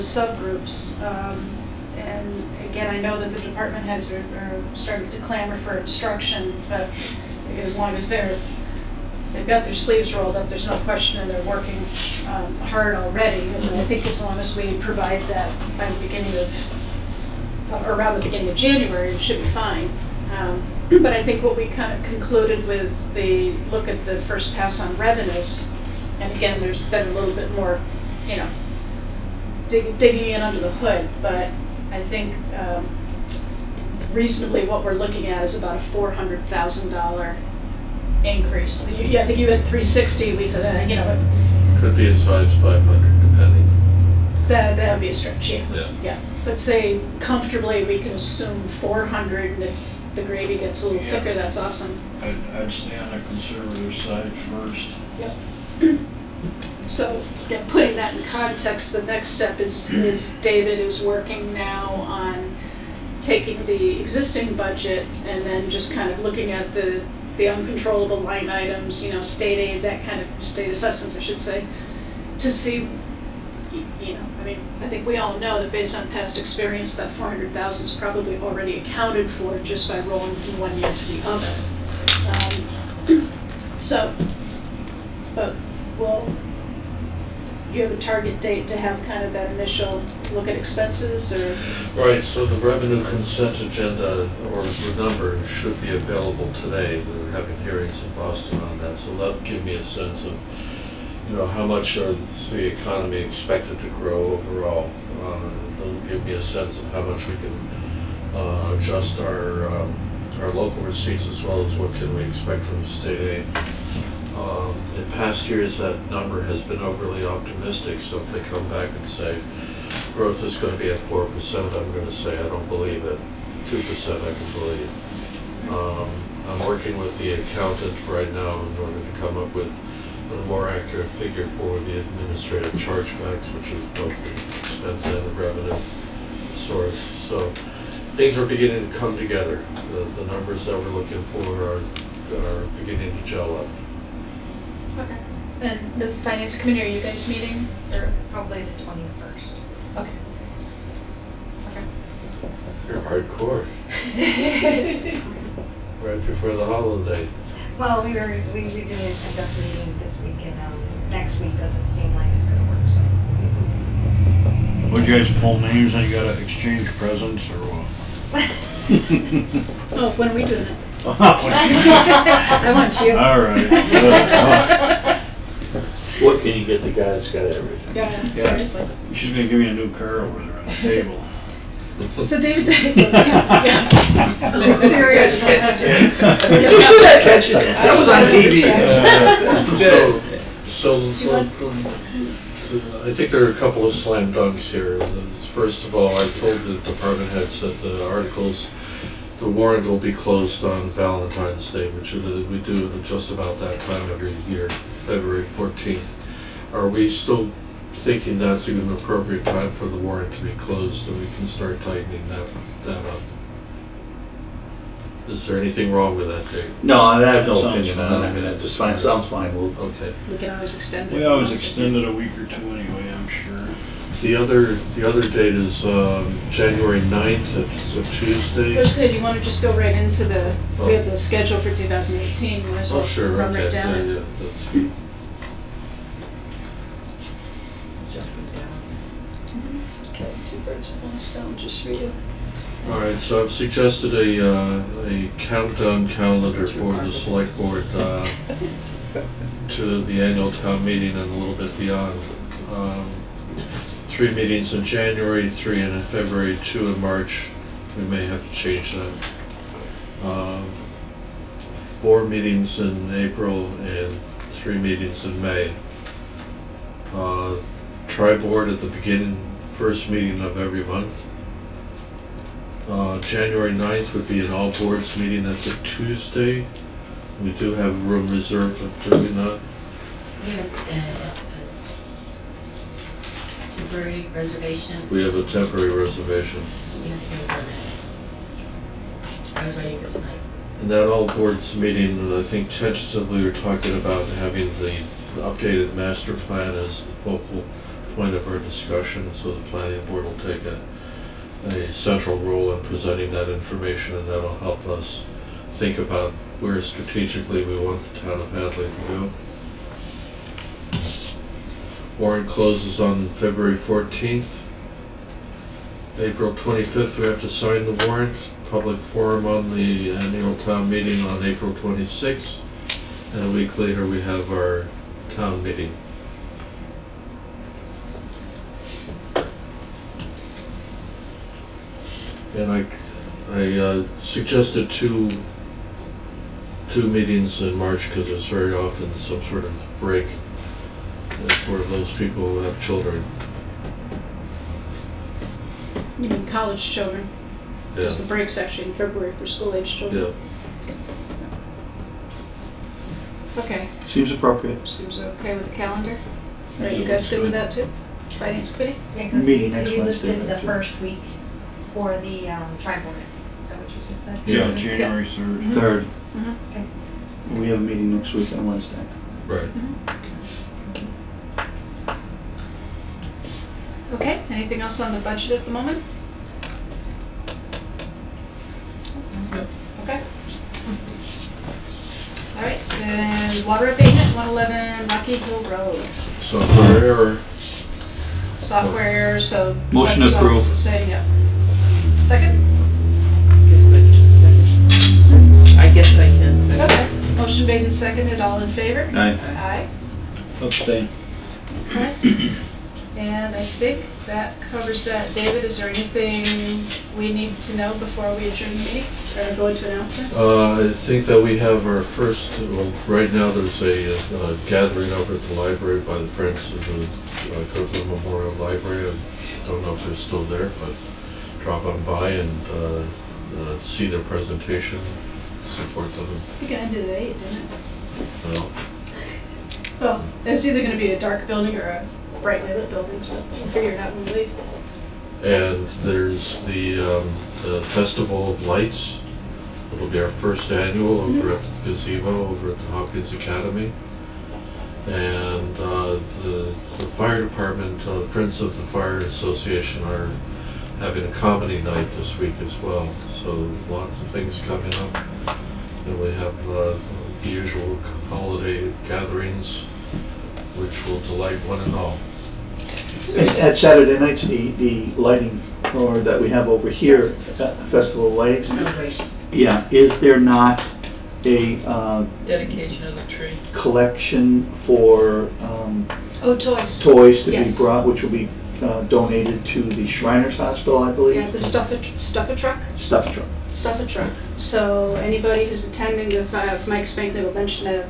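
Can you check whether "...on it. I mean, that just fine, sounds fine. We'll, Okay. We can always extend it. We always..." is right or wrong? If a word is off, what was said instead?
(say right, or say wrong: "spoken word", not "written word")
right.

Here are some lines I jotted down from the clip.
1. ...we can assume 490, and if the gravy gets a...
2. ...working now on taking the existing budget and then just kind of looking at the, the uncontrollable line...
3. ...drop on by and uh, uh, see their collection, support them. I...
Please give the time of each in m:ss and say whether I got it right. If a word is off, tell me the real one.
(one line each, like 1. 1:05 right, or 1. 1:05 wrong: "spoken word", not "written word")
1. 0:47 wrong: "400", not "490"
2. 1:01 right
3. 7:01 wrong: "presentation", not "collection".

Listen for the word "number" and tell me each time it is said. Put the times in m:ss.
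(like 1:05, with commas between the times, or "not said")
1:34, 1:56, 2:20.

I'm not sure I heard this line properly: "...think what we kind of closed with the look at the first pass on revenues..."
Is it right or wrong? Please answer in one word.
wrong.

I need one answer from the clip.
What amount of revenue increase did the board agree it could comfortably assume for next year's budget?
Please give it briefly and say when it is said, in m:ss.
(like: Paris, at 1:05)
$400,000, at 0:35.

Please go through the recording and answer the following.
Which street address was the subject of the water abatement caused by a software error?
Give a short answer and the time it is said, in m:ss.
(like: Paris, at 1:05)
111 Rocky Hill Road, at 6:24.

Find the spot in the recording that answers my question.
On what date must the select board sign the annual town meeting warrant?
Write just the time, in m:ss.
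5:16.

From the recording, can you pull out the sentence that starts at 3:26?
Are we still thinking that's an appropriate time for the warrant to be closed and we can start tightening that, that up?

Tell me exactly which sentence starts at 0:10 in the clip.
There's no question, and they're working um, hard already.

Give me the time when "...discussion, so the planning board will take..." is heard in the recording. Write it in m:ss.
4:58.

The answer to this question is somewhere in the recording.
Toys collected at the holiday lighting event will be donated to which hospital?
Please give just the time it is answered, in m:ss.
8:00.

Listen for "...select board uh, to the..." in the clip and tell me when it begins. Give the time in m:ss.
4:07.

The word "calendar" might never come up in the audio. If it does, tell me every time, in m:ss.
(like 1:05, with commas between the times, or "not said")
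4:06, 5:55.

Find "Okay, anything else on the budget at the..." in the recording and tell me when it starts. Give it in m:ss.
6:14.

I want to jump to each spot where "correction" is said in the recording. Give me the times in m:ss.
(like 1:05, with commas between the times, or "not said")
not said.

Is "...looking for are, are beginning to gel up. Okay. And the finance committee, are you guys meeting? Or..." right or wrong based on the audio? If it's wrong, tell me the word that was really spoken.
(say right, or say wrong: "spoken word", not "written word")
right.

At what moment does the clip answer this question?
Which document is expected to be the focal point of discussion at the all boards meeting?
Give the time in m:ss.
4:55.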